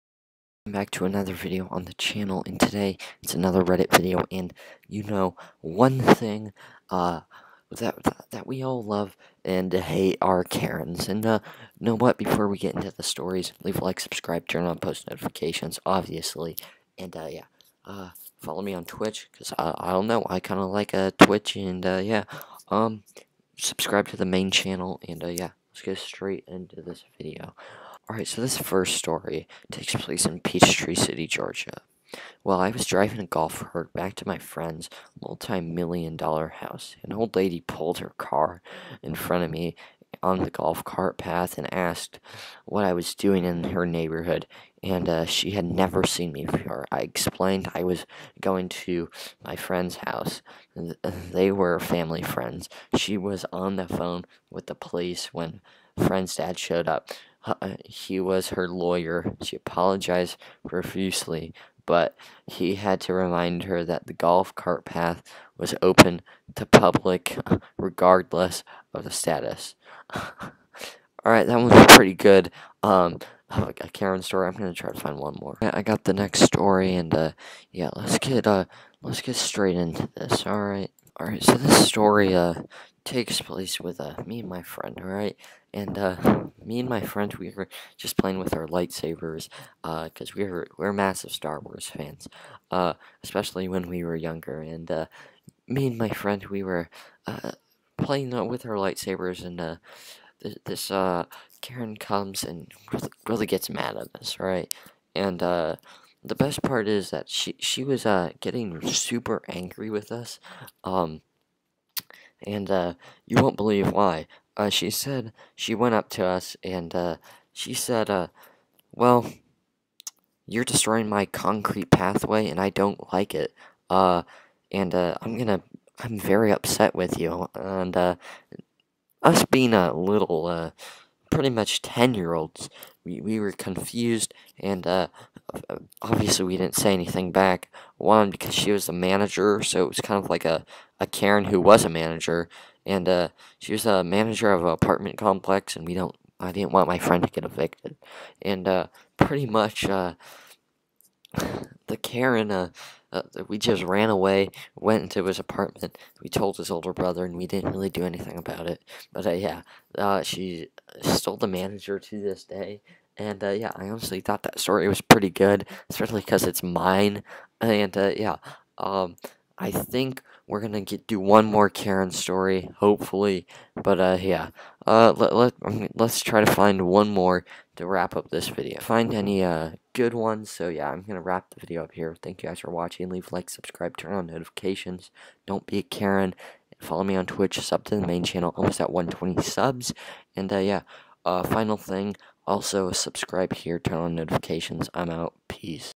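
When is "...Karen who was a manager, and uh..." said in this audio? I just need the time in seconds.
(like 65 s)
141 s.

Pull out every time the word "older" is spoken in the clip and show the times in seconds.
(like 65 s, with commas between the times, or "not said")
156 s.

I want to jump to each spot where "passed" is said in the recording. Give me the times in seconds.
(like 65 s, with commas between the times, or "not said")
not said.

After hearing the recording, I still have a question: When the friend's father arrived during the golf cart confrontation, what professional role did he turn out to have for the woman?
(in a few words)
Her lawyer.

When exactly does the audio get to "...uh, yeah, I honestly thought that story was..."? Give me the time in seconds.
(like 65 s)
163 s.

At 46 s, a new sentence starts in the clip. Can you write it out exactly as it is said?
I explained I was going to my friend's house.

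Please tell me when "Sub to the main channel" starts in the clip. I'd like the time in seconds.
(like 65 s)
187 s.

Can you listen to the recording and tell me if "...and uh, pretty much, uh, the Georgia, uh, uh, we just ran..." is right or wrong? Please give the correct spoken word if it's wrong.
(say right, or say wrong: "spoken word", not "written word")
wrong: "Karen", not "Georgia".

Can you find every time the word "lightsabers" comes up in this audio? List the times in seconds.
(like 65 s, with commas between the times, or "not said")
88 s, 98 s.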